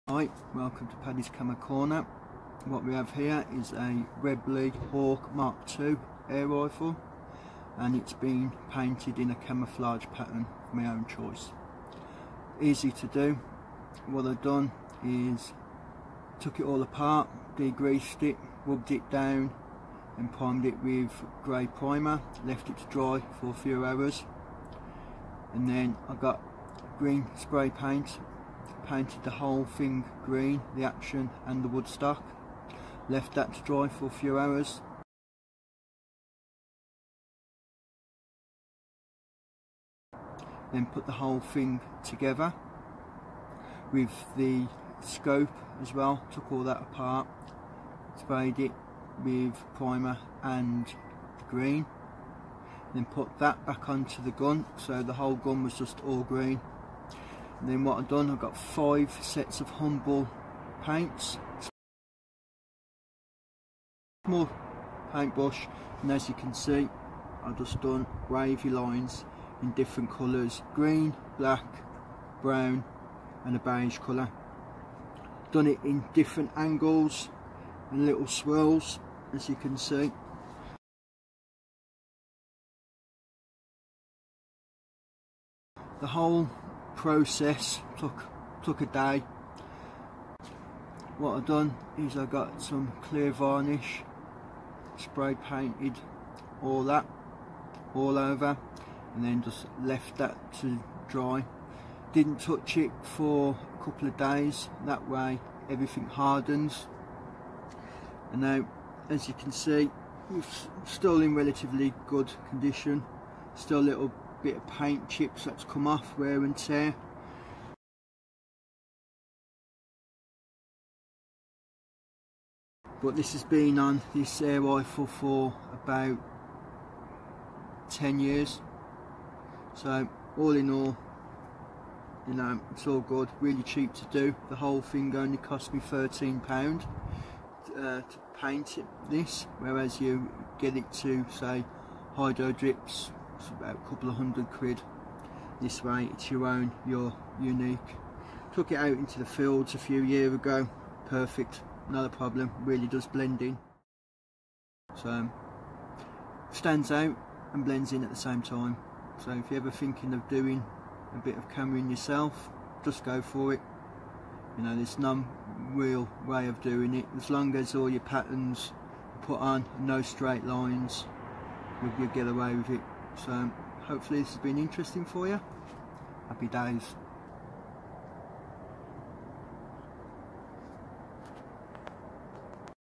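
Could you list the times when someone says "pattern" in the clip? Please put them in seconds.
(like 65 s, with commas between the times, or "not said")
10 s, 168 s.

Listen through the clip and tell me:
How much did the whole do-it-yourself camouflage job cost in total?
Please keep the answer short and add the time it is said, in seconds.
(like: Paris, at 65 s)
13 pounds, at 135 s.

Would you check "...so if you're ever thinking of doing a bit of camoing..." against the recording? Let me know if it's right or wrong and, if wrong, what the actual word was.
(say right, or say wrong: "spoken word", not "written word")
right.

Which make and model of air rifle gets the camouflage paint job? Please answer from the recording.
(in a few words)
Webley Hawk Mark II.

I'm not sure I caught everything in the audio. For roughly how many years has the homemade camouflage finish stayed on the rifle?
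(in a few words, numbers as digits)
10 years.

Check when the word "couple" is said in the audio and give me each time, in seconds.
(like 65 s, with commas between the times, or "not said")
103 s, 143 s.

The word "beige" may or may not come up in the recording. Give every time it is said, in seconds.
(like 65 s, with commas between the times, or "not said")
73 s.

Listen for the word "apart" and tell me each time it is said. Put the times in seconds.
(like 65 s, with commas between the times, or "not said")
16 s, 46 s.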